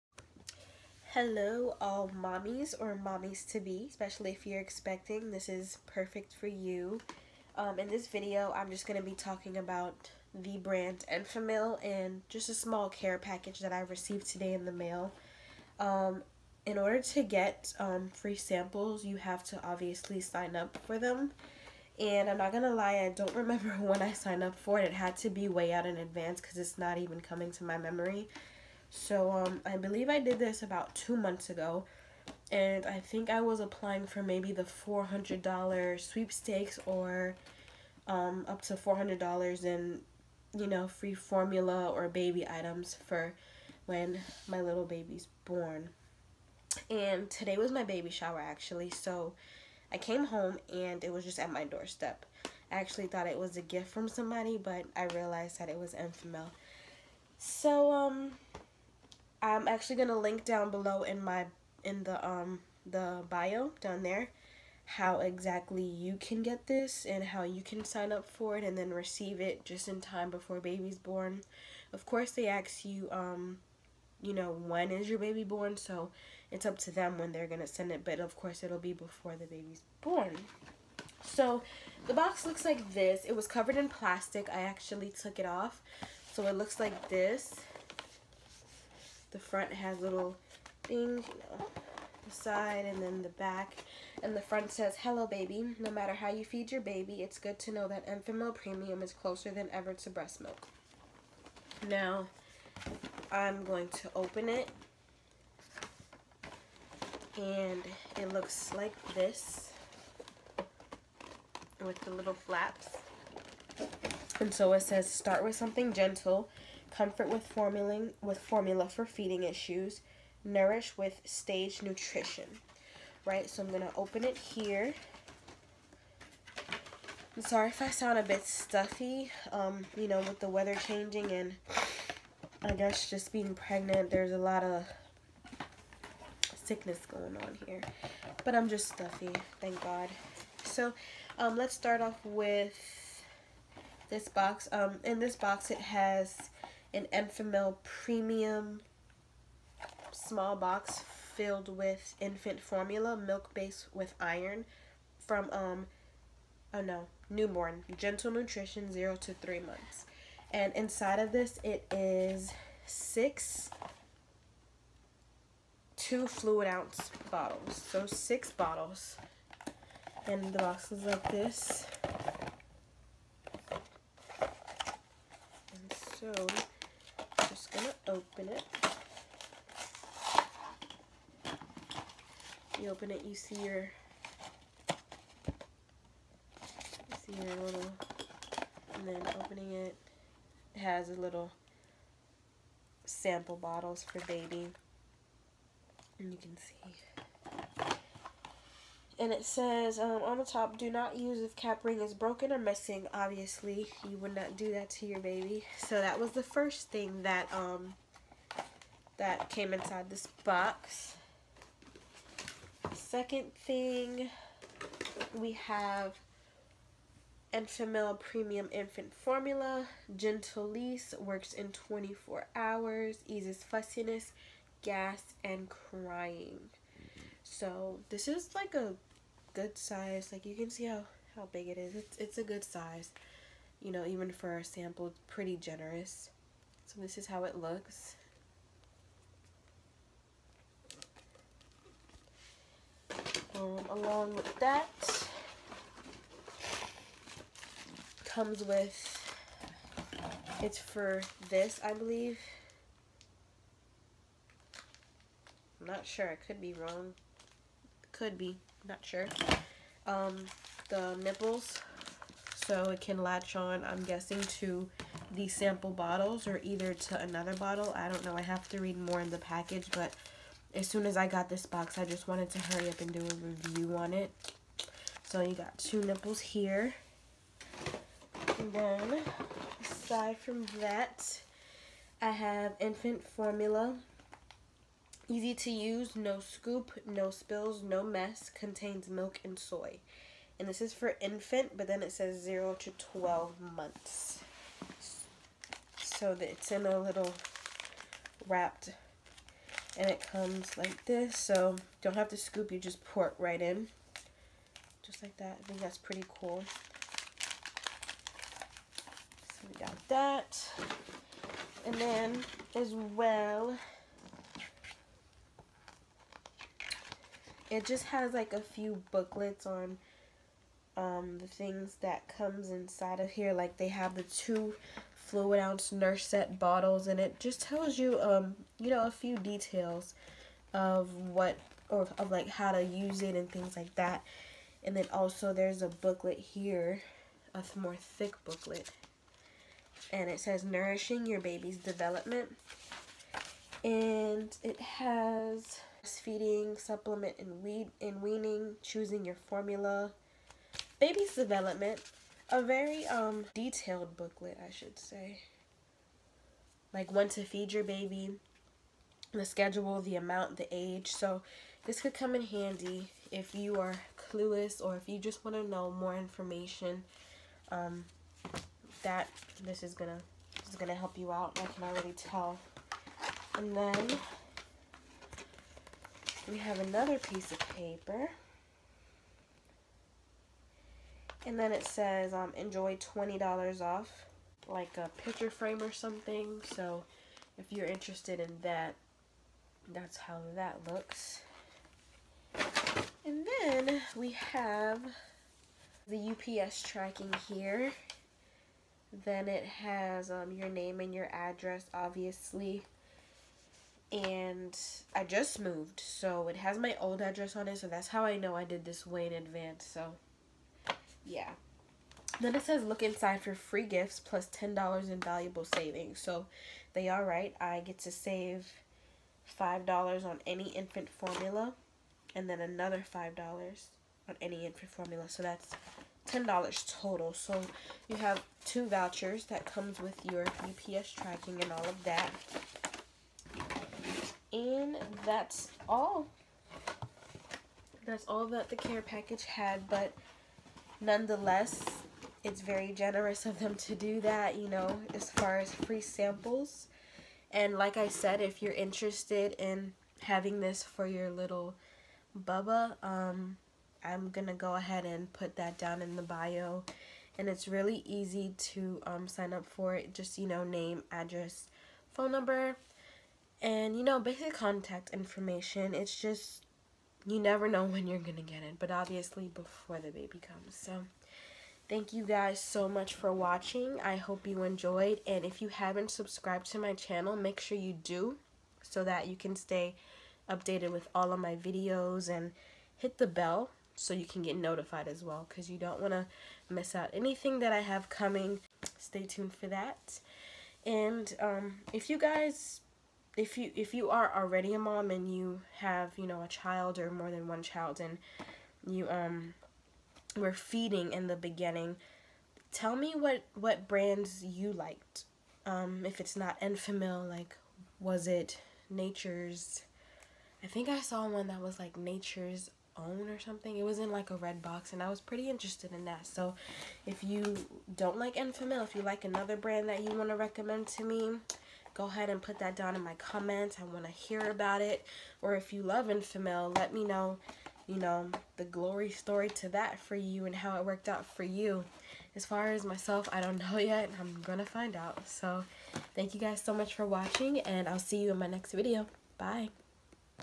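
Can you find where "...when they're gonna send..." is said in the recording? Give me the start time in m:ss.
1:17.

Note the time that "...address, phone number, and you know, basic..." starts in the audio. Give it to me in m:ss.
7:41.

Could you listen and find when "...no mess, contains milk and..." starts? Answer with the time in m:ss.
4:47.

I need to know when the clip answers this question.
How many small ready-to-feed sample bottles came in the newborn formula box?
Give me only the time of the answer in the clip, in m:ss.
2:48.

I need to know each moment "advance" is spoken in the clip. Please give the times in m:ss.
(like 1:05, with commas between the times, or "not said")
0:25, 6:49.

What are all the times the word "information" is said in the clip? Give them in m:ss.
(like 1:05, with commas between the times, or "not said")
6:06, 7:45.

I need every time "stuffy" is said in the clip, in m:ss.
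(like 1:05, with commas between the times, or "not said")
2:08, 2:18.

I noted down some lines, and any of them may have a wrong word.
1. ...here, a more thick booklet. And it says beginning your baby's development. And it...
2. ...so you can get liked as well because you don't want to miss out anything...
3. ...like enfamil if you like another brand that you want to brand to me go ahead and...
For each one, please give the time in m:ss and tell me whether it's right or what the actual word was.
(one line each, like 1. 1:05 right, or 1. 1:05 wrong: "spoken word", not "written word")
1. 5:36 wrong: "nourishing", not "beginning"
2. 8:03 wrong: "notified", not "liked"
3. 8:38 wrong: "recommend", not "brand".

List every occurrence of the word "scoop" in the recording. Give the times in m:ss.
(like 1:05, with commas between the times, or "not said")
4:46, 5:02.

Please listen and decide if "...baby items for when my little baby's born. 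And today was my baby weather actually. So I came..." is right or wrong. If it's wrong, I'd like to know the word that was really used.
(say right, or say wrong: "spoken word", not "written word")
wrong: "shower", not "weather".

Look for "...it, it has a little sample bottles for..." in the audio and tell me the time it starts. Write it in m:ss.
3:09.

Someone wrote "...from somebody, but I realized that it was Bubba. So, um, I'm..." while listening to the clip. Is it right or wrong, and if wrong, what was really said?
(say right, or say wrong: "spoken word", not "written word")
wrong: "Enfamil", not "Bubba".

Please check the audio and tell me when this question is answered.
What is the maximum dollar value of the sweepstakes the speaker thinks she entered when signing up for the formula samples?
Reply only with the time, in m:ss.
0:34.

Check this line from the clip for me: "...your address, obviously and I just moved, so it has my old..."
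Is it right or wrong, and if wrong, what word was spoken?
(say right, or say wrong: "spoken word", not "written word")
right.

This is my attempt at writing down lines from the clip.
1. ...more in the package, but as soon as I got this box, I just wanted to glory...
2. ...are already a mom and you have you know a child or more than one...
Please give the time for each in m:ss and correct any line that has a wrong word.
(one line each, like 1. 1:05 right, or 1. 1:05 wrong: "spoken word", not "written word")
1. 4:28 wrong: "hurry", not "glory"
2. 8:14 right.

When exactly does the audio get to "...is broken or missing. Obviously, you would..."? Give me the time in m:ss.
3:22.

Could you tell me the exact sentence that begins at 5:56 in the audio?
Like when to feed your baby, the schedule, the amount, the age.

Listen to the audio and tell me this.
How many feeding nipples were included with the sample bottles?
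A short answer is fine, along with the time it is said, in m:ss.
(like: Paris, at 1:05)
2, at 4:35.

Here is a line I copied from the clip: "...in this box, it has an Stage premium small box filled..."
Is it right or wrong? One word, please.
wrong.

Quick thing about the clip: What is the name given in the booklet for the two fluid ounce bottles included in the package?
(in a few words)
Nursette.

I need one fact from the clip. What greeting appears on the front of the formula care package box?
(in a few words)
Hello baby.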